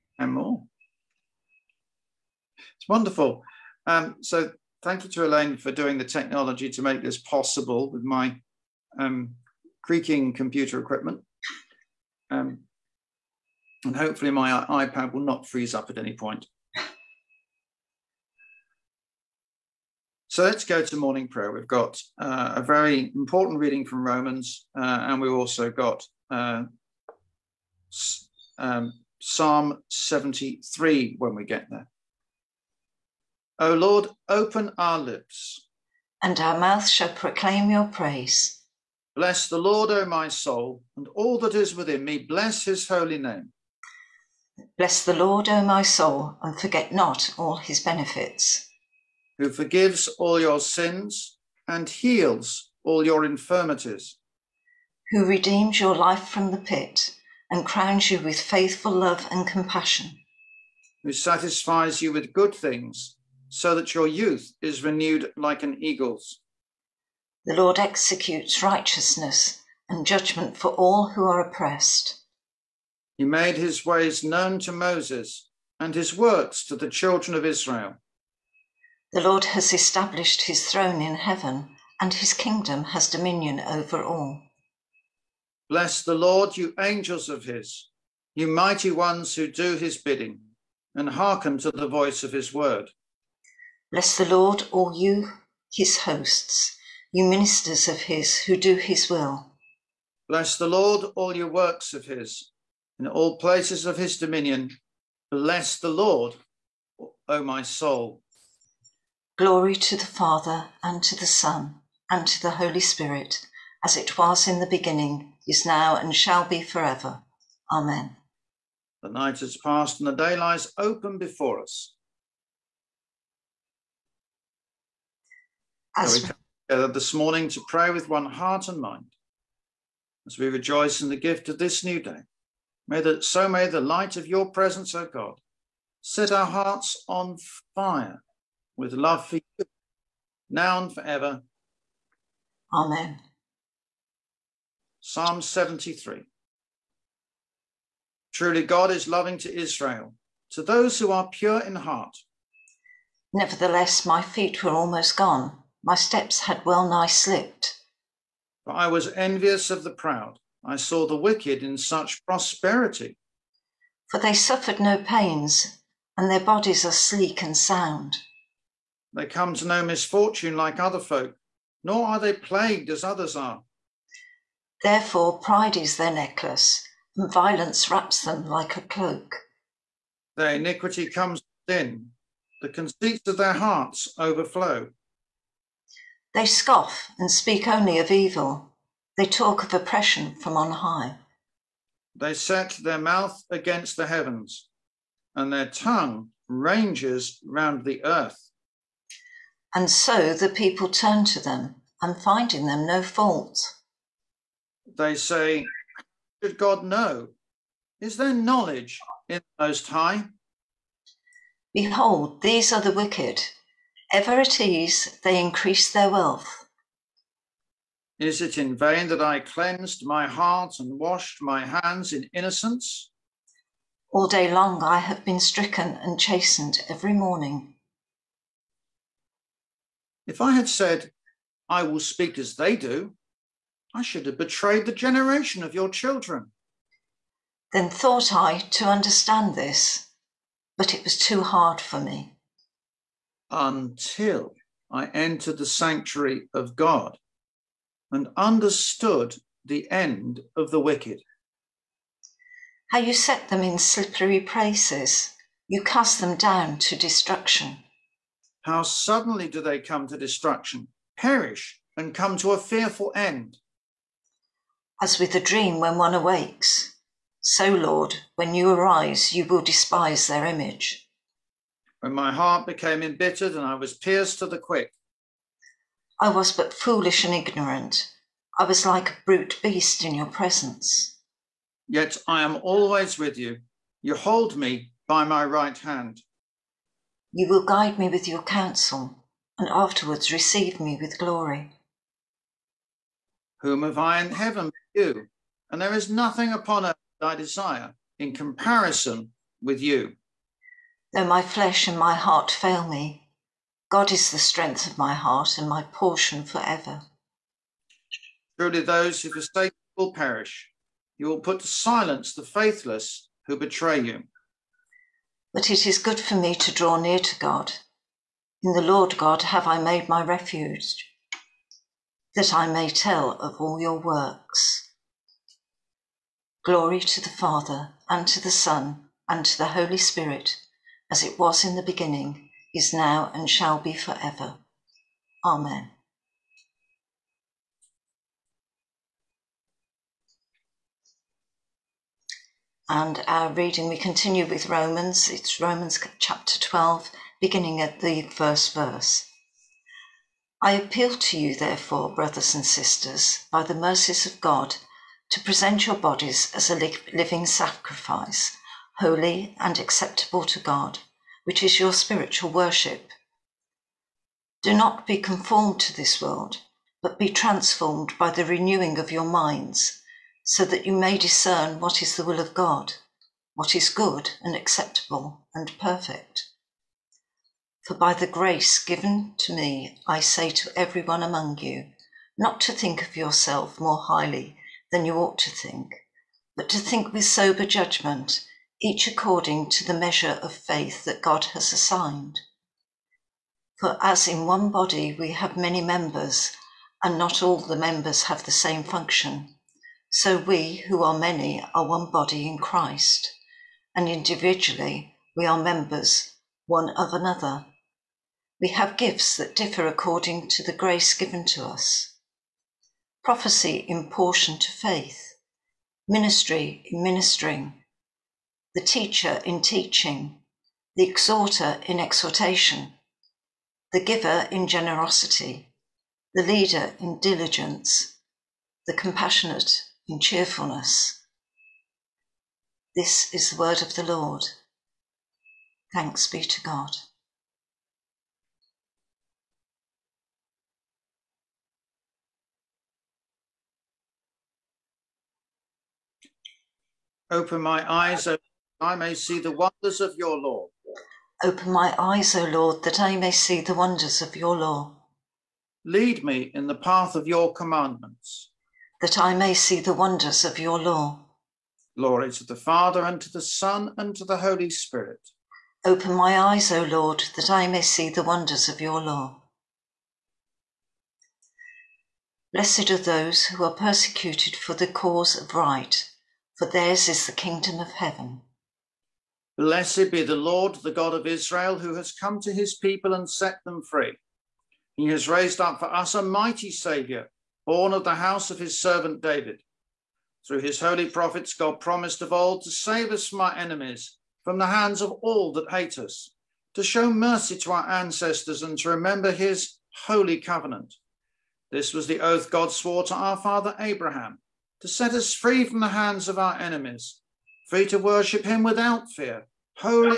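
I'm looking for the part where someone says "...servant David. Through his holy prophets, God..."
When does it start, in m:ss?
8:08.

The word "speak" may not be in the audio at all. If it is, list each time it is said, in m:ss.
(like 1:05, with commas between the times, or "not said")
3:07, 3:52.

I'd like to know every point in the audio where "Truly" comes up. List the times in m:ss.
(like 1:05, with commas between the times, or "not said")
2:28, 5:08.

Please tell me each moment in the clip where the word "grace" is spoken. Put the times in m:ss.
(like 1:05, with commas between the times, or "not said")
6:18, 6:50.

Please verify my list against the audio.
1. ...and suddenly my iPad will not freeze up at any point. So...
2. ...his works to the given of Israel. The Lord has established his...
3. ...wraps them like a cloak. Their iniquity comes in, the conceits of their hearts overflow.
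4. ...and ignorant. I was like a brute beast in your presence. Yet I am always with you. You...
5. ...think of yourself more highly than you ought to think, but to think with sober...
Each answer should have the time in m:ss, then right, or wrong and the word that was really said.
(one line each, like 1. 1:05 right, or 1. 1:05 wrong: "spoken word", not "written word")
1. 0:13 wrong: "hopefully", not "suddenly"
2. 1:15 wrong: "children", not "given"
3. 2:57 right
4. 4:37 right
5. 6:22 right.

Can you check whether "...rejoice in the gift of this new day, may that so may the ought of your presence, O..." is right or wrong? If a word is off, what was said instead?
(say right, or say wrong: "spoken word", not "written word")
wrong: "light", not "ought".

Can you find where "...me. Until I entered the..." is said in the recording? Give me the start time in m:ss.
4:01.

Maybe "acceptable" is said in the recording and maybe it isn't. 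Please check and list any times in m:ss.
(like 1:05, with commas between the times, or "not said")
5:59, 6:14.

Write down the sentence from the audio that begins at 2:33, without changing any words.
Nevertheless, my feet were almost gone.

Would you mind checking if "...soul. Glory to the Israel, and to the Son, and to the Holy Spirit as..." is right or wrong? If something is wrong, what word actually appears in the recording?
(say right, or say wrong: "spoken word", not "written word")
wrong: "Father", not "Israel".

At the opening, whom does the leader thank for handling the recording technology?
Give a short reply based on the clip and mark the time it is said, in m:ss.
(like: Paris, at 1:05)
Elaine, at 0:05.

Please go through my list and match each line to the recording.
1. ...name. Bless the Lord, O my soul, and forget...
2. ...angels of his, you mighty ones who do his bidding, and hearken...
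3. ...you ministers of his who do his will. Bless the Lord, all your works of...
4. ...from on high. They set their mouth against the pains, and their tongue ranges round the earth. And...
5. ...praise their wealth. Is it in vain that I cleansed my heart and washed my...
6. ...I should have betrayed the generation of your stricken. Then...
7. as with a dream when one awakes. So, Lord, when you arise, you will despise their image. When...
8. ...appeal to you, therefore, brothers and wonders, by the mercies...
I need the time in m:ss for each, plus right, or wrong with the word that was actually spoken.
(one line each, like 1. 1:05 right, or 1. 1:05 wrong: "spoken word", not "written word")
1. 0:43 right
2. 1:26 right
3. 1:37 right
4. 3:10 wrong: "heavens", not "pains"
5. 3:35 wrong: "increase", not "praise"
6. 3:53 wrong: "children", not "stricken"
7. 4:25 right
8. 5:50 wrong: "sisters", not "wonders".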